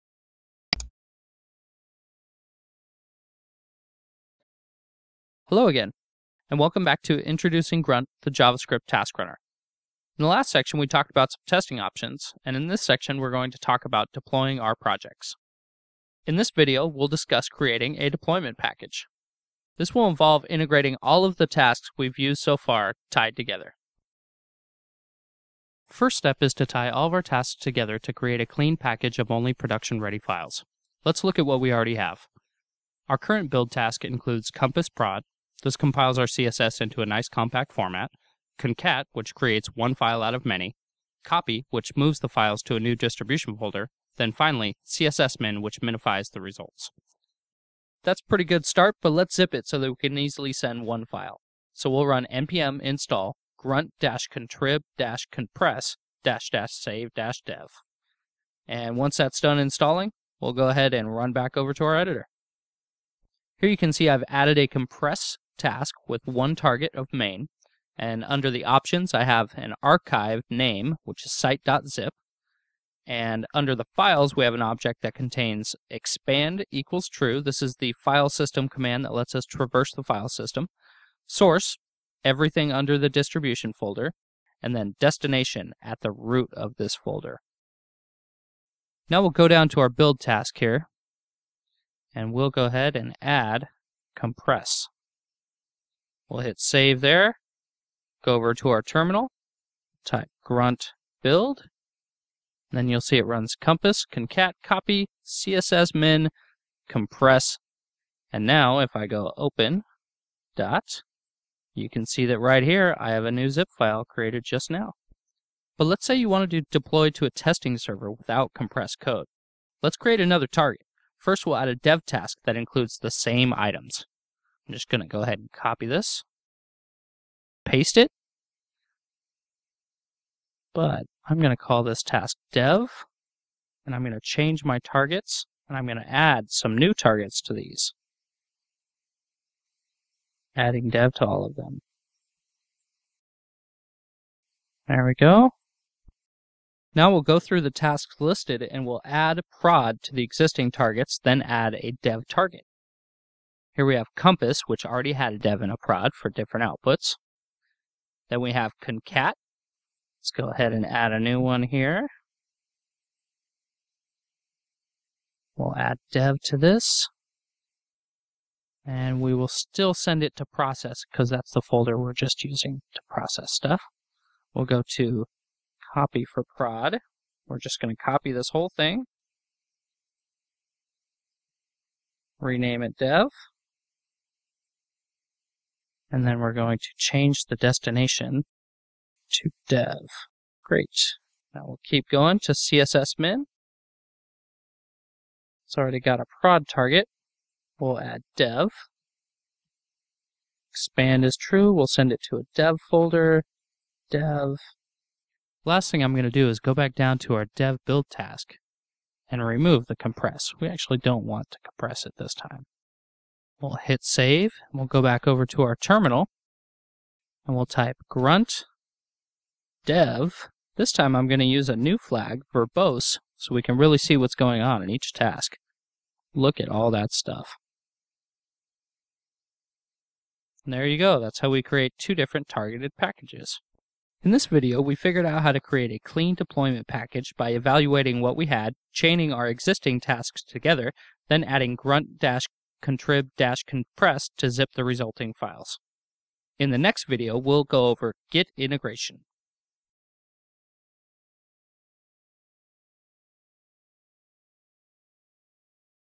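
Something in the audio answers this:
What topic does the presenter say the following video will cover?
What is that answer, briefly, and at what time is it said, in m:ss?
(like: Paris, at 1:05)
Git integration, at 4:08.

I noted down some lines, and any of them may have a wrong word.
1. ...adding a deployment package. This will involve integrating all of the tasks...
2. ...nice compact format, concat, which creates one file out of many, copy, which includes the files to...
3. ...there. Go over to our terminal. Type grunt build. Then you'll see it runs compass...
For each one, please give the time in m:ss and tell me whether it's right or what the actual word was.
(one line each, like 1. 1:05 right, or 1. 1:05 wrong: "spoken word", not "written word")
1. 0:17 wrong: "creating", not "adding"
2. 0:37 wrong: "moves", not "includes"
3. 1:37 right.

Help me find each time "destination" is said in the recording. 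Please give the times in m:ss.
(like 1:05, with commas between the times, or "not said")
1:24, 3:07.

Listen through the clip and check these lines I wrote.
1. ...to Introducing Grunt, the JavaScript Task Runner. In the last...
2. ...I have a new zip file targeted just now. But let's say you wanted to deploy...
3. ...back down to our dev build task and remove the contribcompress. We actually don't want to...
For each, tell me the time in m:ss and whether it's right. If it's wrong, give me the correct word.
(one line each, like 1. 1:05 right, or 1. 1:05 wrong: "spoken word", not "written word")
1. 0:07 right
2. 1:52 wrong: "created", not "targeted"
3. 3:26 wrong: "compress", not "contribcompress".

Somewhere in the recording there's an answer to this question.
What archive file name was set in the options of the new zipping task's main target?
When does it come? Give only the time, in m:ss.
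1:11.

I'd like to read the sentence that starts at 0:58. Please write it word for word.
And once that's done installing, we'll go ahead and run back over to our editor.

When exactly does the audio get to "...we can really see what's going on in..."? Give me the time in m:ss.
3:43.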